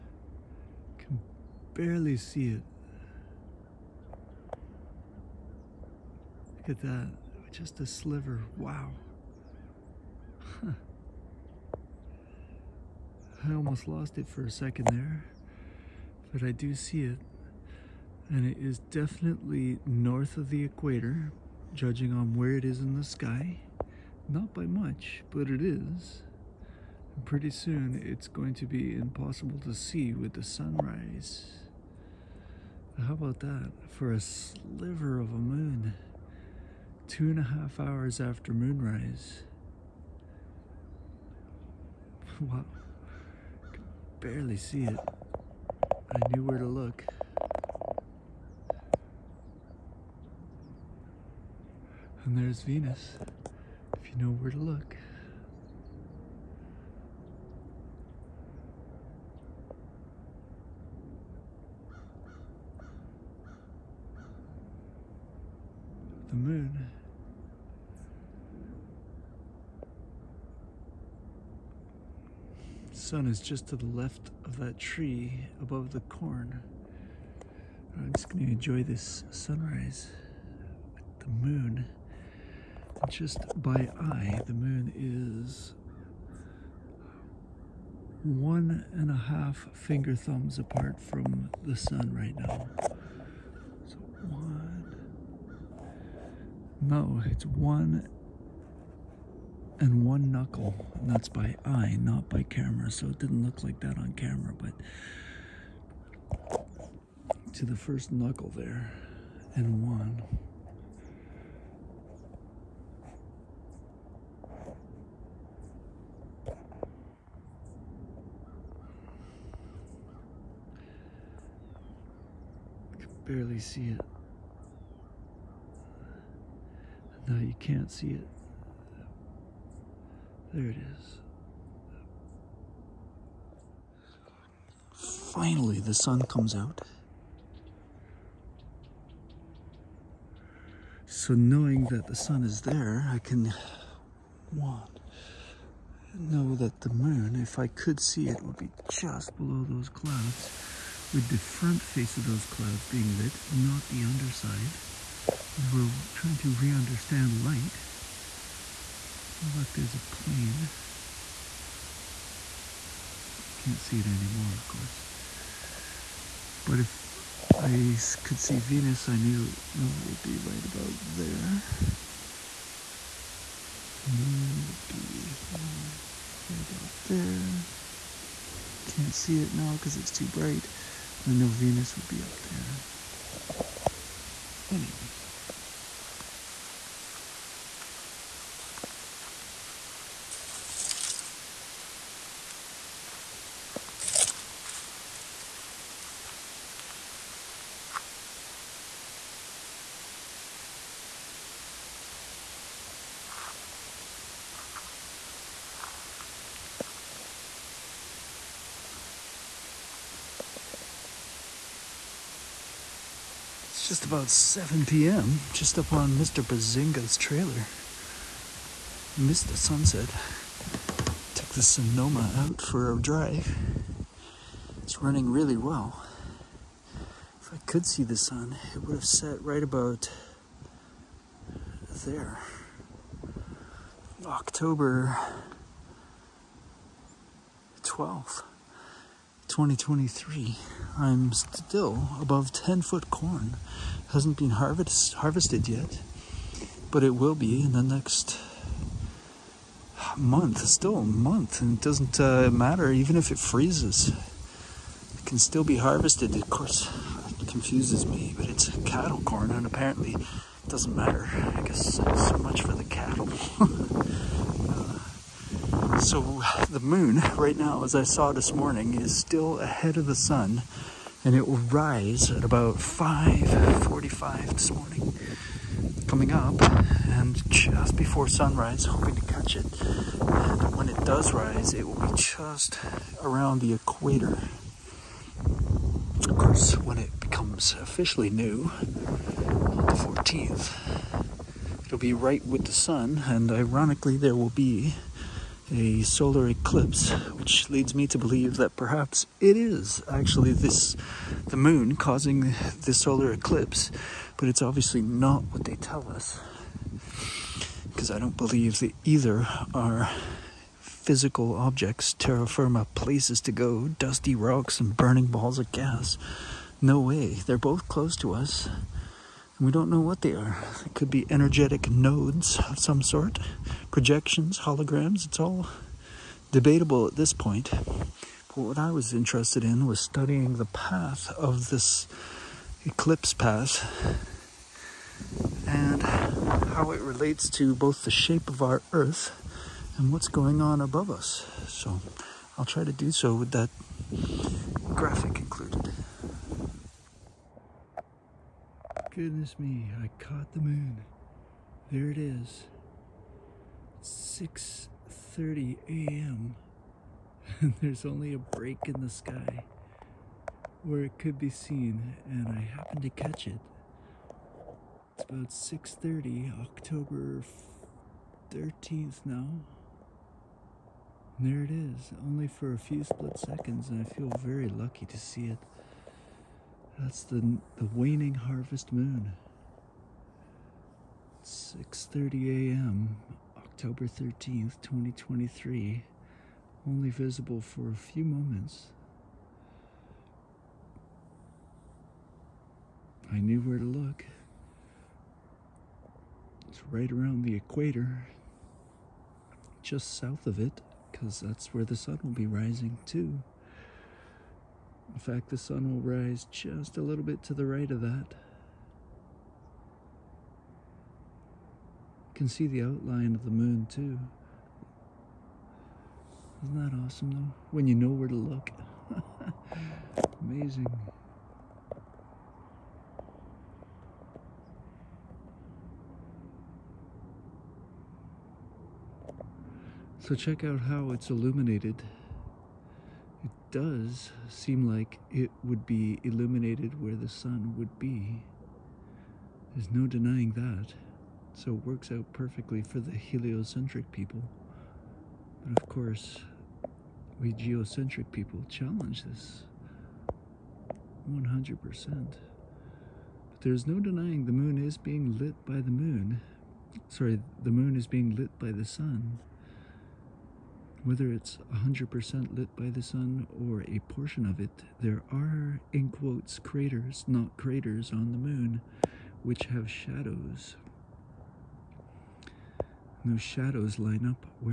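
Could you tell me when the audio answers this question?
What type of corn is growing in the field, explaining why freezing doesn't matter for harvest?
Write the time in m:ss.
4:18.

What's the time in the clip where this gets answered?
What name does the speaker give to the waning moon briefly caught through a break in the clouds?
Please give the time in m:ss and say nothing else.
6:18.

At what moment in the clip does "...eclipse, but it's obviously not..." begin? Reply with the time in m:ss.
5:03.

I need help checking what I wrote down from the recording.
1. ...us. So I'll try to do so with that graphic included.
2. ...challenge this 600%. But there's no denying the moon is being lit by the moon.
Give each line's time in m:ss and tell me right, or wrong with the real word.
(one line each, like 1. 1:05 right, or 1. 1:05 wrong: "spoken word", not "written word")
1. 5:41 right
2. 7:28 wrong: "100", not "600".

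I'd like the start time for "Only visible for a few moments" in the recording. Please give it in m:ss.
6:26.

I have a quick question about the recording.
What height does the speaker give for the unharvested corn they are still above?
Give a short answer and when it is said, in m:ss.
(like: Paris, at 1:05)
10 foot, at 4:02.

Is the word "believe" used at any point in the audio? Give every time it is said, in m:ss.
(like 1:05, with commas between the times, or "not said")
4:58, 5:08.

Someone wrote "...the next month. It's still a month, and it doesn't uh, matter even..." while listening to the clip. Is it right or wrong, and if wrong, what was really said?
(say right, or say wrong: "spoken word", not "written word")
right.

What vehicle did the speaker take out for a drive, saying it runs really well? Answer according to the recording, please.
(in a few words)
Sonoma.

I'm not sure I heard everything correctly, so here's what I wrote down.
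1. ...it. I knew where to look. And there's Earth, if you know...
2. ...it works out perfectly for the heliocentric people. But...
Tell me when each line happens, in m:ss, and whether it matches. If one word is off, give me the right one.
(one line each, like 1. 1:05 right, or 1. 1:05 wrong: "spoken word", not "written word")
1. 0:44 wrong: "Venus", not "Earth"
2. 7:21 right.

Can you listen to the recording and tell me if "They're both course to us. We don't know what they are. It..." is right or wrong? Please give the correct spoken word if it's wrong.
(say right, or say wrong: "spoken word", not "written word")
wrong: "close", not "course".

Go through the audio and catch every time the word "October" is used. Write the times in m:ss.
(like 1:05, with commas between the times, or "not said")
3:54, 6:06, 6:23.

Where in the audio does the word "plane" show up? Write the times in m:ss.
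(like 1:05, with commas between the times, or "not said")
2:40.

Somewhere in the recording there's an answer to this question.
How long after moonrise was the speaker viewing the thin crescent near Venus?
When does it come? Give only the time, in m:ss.
0:37.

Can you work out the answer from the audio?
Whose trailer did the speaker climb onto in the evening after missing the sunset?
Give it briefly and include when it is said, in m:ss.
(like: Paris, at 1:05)
Mr. Bazinga's, at 3:36.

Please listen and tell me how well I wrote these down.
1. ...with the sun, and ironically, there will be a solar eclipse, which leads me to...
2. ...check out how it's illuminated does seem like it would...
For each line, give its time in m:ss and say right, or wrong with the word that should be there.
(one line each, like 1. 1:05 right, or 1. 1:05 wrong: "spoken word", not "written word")
1. 4:52 right
2. 7:10 right.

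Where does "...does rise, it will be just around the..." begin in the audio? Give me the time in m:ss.
4:41.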